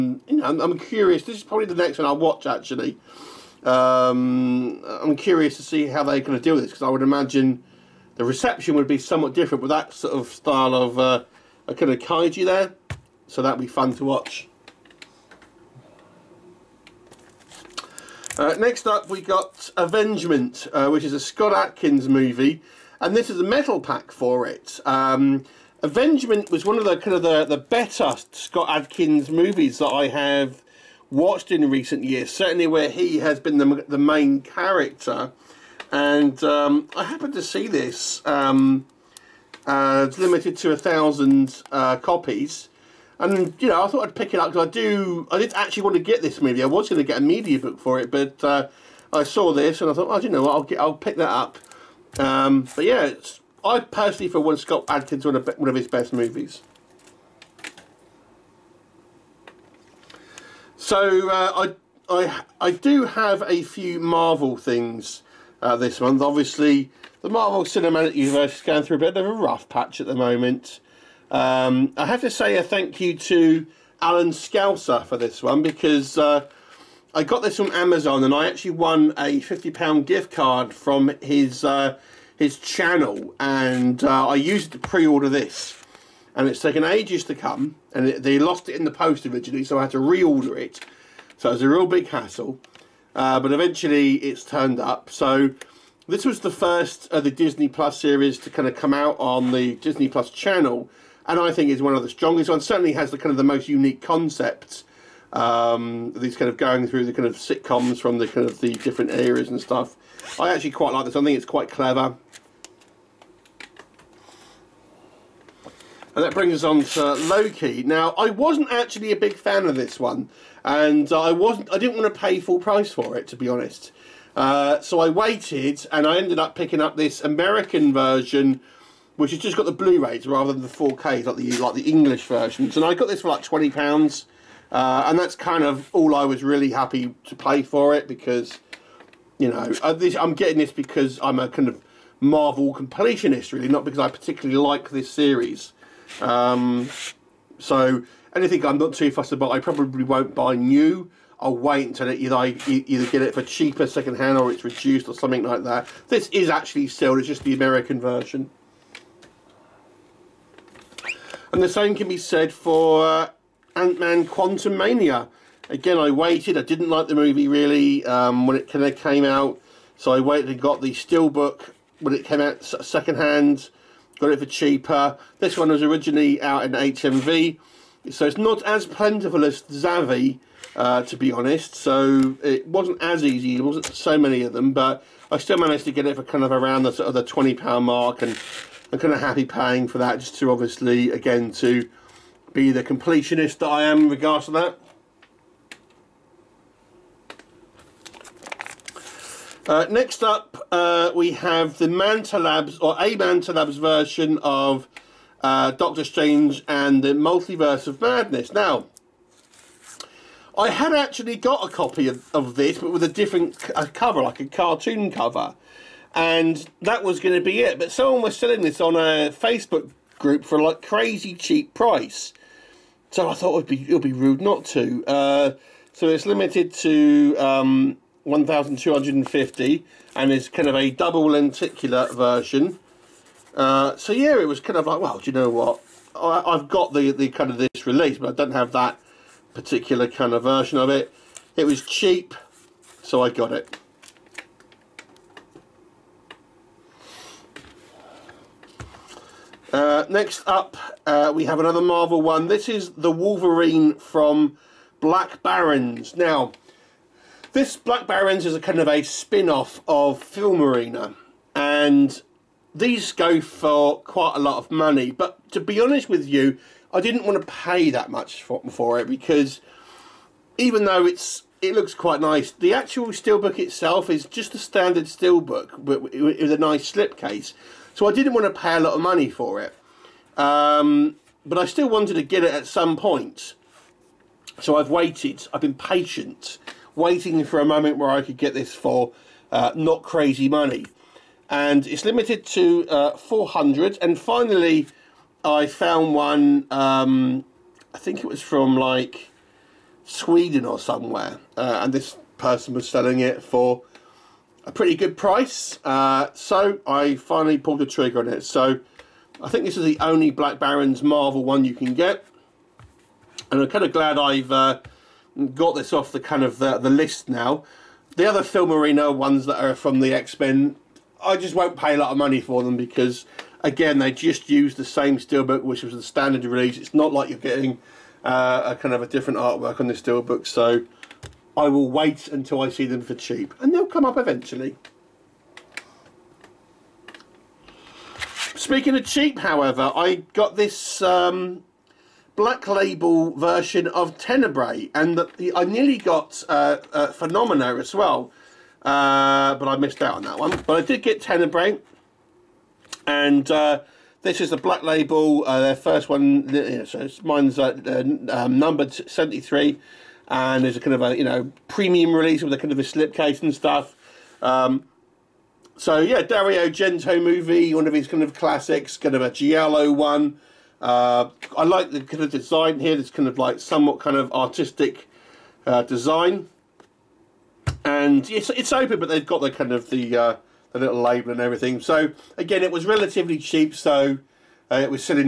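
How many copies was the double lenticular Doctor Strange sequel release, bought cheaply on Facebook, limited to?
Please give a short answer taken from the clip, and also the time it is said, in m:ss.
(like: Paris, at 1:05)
1250, at 3:48.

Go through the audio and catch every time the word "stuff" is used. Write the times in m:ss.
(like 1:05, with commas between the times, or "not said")
1:49, 6:03.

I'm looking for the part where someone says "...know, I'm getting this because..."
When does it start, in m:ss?
2:19.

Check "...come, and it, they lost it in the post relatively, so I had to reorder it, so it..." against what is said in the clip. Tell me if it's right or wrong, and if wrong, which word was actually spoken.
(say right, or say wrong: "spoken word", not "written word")
wrong: "originally", not "relatively".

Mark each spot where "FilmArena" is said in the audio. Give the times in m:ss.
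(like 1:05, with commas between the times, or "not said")
4:20, 5:18.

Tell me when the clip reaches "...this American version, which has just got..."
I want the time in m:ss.
2:06.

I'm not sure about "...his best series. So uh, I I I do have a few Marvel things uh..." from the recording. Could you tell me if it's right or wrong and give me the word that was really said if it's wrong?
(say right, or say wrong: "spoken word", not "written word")
wrong: "movies", not "series".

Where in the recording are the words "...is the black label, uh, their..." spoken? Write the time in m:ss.
5:54.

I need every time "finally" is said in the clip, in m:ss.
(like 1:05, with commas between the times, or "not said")
4:54, 5:07.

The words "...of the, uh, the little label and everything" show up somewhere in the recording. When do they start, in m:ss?
6:19.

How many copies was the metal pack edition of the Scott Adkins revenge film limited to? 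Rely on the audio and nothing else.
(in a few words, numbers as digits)
1000.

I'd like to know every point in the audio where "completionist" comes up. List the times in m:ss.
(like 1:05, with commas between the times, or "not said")
2:22, 3:12.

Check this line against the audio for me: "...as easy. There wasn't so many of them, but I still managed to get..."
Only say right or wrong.
right.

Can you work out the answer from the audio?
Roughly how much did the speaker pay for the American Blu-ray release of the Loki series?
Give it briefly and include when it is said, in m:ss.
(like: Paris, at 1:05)
£20, at 2:13.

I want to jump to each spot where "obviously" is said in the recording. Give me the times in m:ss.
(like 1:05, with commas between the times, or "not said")
1:06, 3:10.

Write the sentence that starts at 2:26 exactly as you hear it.
Um, so anything I'm not too fussed about, I probably won't buy new.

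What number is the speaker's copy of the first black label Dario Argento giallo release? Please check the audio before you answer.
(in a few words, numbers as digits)
73.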